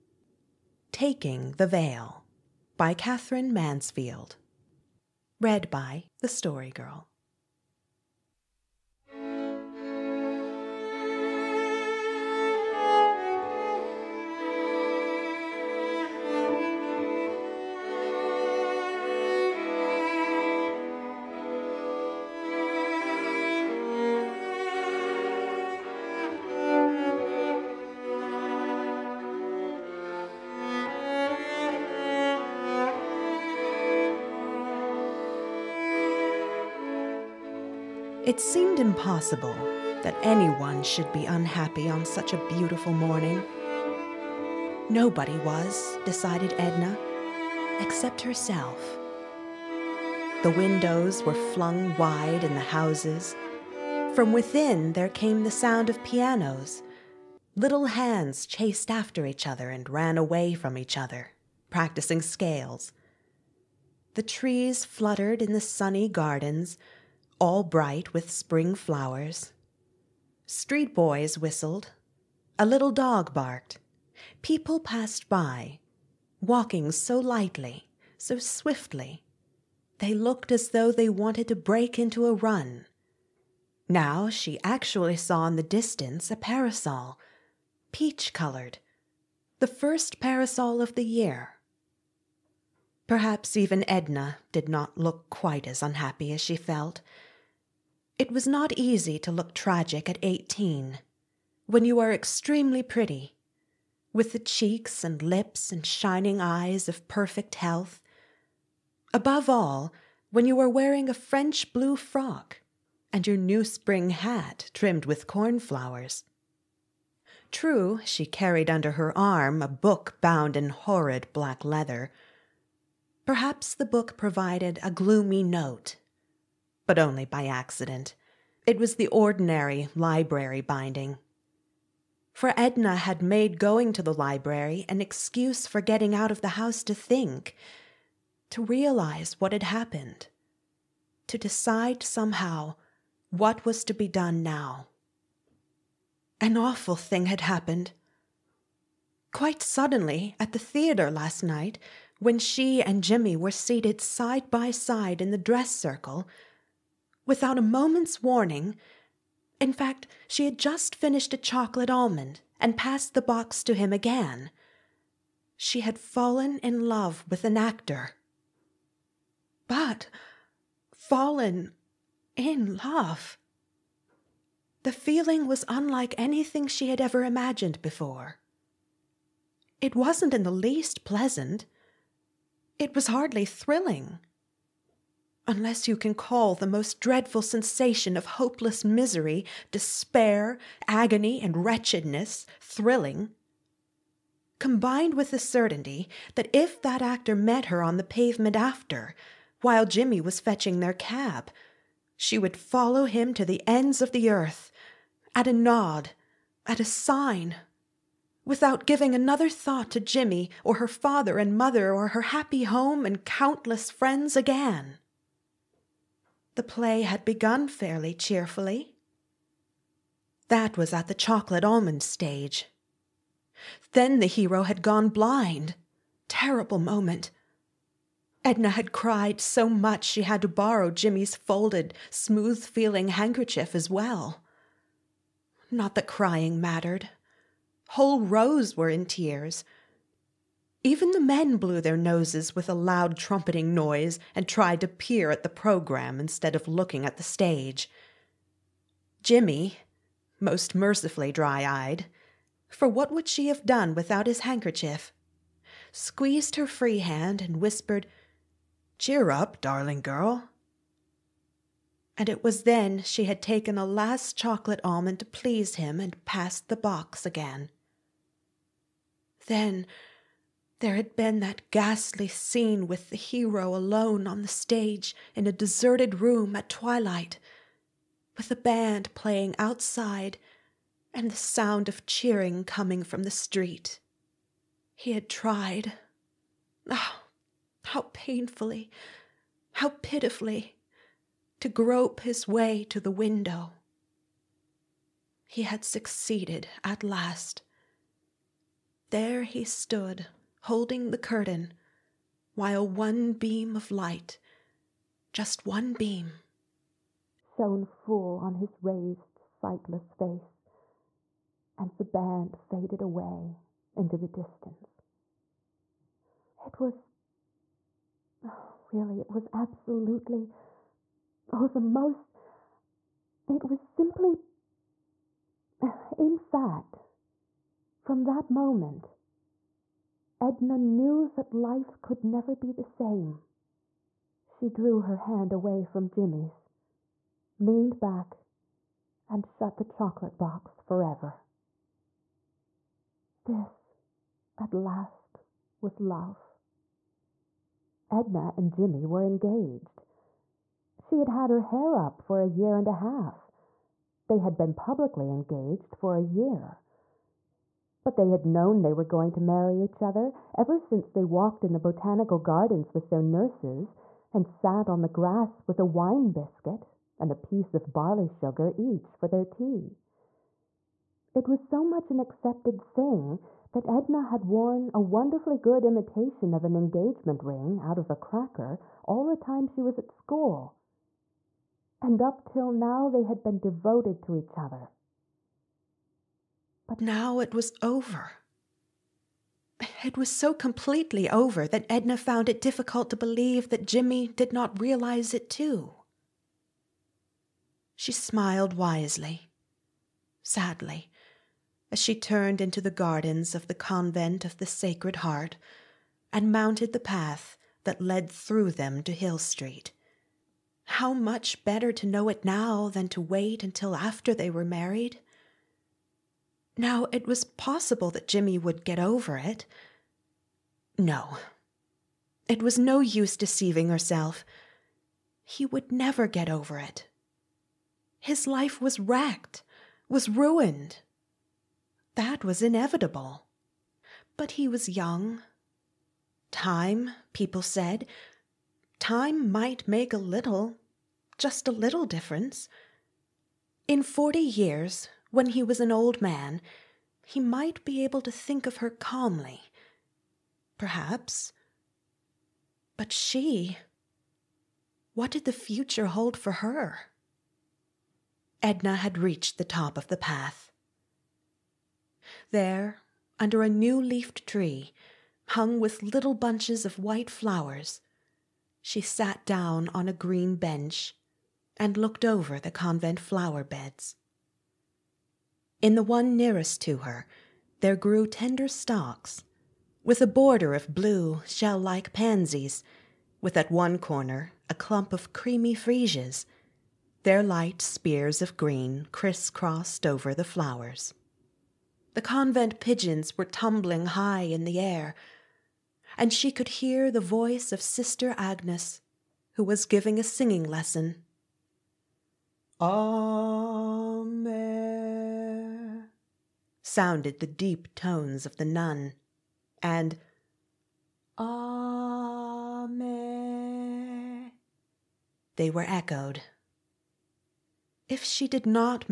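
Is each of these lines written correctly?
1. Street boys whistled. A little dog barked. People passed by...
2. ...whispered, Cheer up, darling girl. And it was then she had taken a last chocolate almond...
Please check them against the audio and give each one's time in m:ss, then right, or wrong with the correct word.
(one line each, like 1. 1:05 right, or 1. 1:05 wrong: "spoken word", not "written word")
1. 1:10 right
2. 4:17 right.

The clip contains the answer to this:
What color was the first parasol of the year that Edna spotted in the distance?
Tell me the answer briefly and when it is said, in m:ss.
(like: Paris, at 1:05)
Peach, at 1:27.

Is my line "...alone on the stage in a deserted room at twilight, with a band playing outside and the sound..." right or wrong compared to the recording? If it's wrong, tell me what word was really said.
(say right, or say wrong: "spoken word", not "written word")
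right.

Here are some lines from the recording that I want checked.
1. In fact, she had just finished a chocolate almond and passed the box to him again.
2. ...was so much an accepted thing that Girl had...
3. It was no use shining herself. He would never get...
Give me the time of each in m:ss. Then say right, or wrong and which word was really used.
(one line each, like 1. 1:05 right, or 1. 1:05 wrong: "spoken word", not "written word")
1. 2:39 right
2. 6:11 wrong: "Edna", not "Girl"
3. 7:02 wrong: "deceiving", not "shining".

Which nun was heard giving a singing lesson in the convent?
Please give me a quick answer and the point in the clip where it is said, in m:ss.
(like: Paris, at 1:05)
Sister Agnes, at 8:17.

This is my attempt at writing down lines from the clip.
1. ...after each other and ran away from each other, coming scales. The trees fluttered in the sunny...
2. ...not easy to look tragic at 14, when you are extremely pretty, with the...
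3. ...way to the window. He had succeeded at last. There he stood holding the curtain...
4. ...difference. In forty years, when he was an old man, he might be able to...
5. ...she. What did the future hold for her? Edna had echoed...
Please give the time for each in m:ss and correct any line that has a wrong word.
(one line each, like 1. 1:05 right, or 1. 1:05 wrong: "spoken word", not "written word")
1. 0:58 wrong: "practicing", not "coming"
2. 1:38 wrong: "18", not "14"
3. 4:52 right
4. 7:22 right
5. 7:33 wrong: "reached", not "echoed".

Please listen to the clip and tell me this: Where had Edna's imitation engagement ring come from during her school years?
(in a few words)
A cracker.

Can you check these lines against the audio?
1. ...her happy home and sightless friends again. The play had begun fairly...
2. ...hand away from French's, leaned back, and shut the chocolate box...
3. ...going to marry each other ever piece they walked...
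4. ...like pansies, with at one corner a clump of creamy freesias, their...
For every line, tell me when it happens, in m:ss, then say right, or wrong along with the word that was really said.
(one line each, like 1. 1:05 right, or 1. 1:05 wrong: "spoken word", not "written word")
1. 3:32 wrong: "countless", not "sightless"
2. 5:35 wrong: "Jimmy", not "French"
3. 5:59 wrong: "since", not "piece"
4. 8:01 right.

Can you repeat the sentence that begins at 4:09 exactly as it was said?
Jimmy, most mercifully dry eyed, for what would she have done without his handkerchief?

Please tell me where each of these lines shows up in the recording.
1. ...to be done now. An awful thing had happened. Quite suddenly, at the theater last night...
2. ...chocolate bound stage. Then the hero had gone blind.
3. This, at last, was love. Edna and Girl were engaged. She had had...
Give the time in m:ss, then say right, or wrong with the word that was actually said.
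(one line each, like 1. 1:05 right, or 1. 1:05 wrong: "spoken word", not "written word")
1. 2:23 right
2. 3:41 wrong: "almond", not "bound"
3. 5:43 wrong: "Jimmy", not "Girl".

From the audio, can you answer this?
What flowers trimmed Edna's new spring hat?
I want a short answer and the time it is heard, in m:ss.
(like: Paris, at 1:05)
Cornflowers, at 1:55.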